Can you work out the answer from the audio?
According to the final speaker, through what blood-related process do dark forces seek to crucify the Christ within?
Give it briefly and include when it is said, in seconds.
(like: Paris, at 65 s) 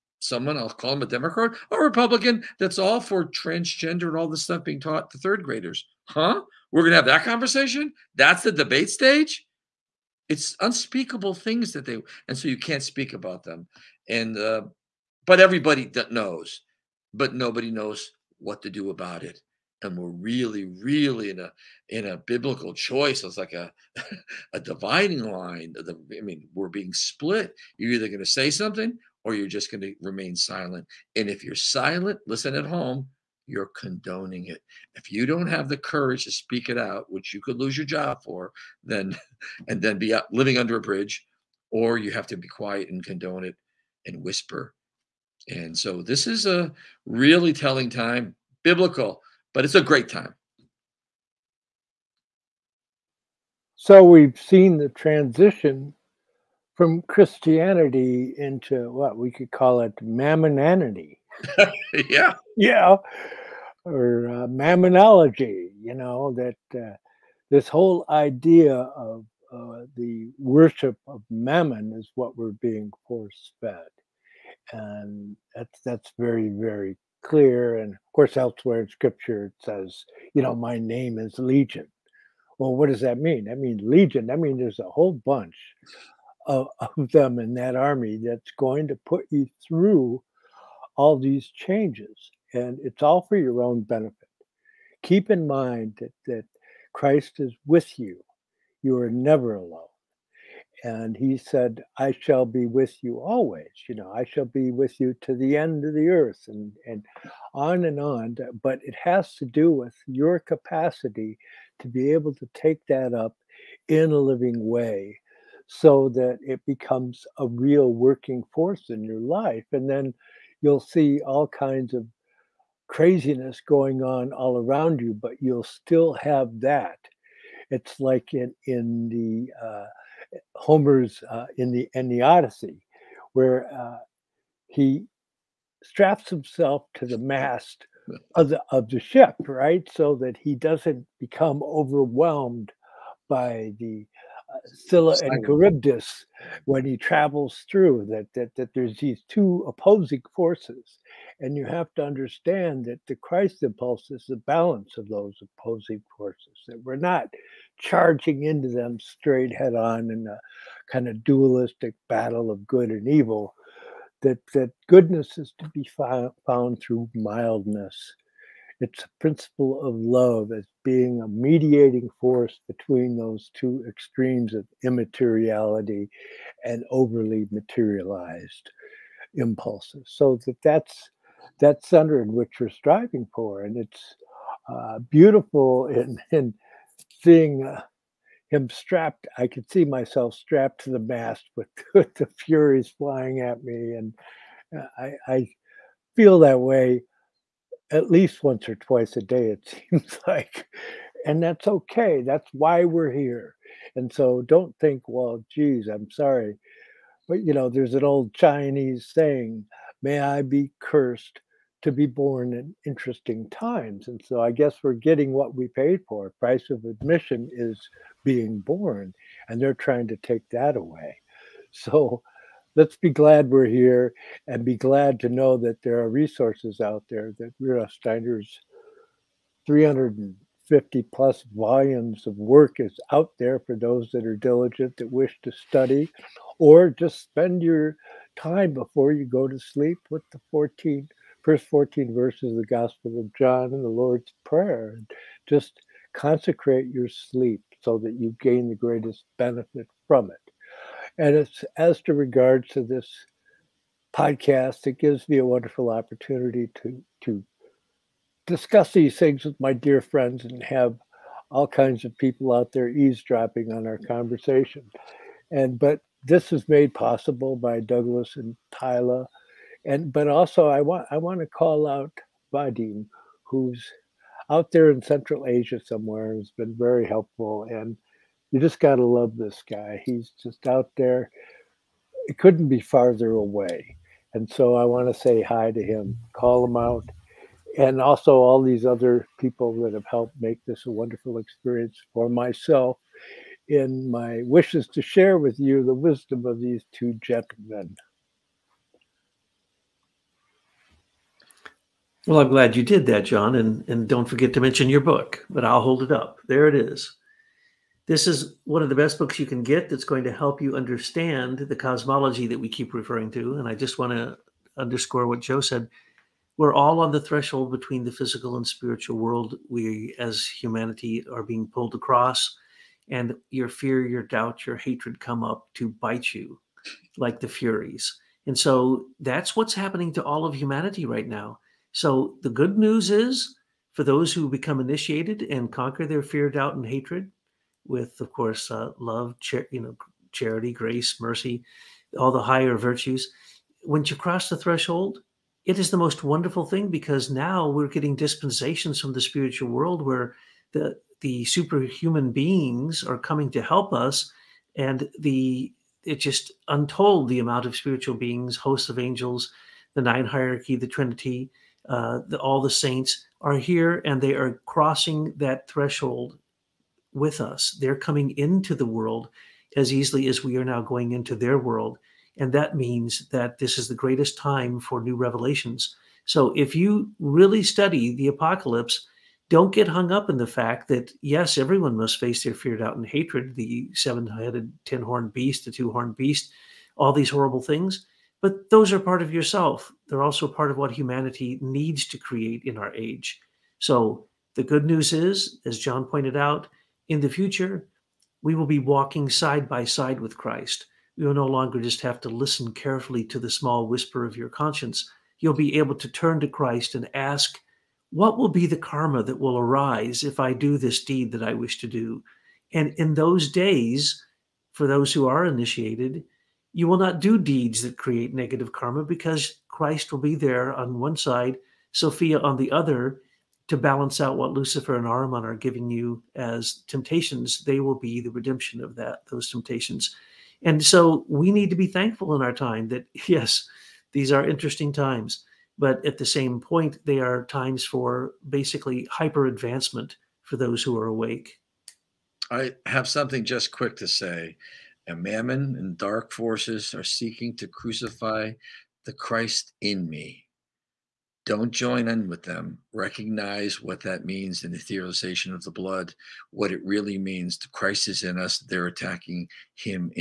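etherization of the blood, at 454 s.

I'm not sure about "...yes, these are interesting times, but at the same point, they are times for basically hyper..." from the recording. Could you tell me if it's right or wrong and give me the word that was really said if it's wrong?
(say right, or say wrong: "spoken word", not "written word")
right.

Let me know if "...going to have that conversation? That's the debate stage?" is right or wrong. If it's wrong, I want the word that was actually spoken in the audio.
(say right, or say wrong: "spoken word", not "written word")
right.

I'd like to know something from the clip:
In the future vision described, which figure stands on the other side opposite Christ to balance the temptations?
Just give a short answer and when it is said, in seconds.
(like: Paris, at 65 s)
Sophia, at 421 s.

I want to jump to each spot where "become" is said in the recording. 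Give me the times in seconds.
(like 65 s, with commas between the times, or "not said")
116 s, 141 s, 334 s.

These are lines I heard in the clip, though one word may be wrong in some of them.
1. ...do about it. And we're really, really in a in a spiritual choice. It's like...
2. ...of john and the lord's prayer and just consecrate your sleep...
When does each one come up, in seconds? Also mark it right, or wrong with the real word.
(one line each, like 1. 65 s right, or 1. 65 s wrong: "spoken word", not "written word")
1. 18 s wrong: "biblical", not "spiritual"
2. 243 s right.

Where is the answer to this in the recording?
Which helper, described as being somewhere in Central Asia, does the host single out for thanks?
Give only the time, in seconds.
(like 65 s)
272 s.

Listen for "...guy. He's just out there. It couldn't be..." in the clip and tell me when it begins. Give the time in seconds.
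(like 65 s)
279 s.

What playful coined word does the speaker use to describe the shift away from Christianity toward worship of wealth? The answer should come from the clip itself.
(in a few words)
mammonanity.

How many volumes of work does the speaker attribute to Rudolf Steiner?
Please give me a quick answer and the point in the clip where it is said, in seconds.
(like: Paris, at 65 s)
350 plus, at 229 s.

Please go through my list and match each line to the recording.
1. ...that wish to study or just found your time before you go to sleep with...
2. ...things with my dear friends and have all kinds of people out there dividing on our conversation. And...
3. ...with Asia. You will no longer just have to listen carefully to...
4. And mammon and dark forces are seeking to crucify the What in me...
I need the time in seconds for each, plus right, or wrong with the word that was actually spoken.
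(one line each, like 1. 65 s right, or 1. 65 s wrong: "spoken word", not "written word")
1. 234 s wrong: "spend", not "found"
2. 259 s wrong: "eavesdropping", not "dividing"
3. 400 s wrong: "Christ", not "Asia"
4. 445 s wrong: "Christ", not "What".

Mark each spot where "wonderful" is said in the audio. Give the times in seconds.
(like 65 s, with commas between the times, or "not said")
255 s, 290 s, 346 s.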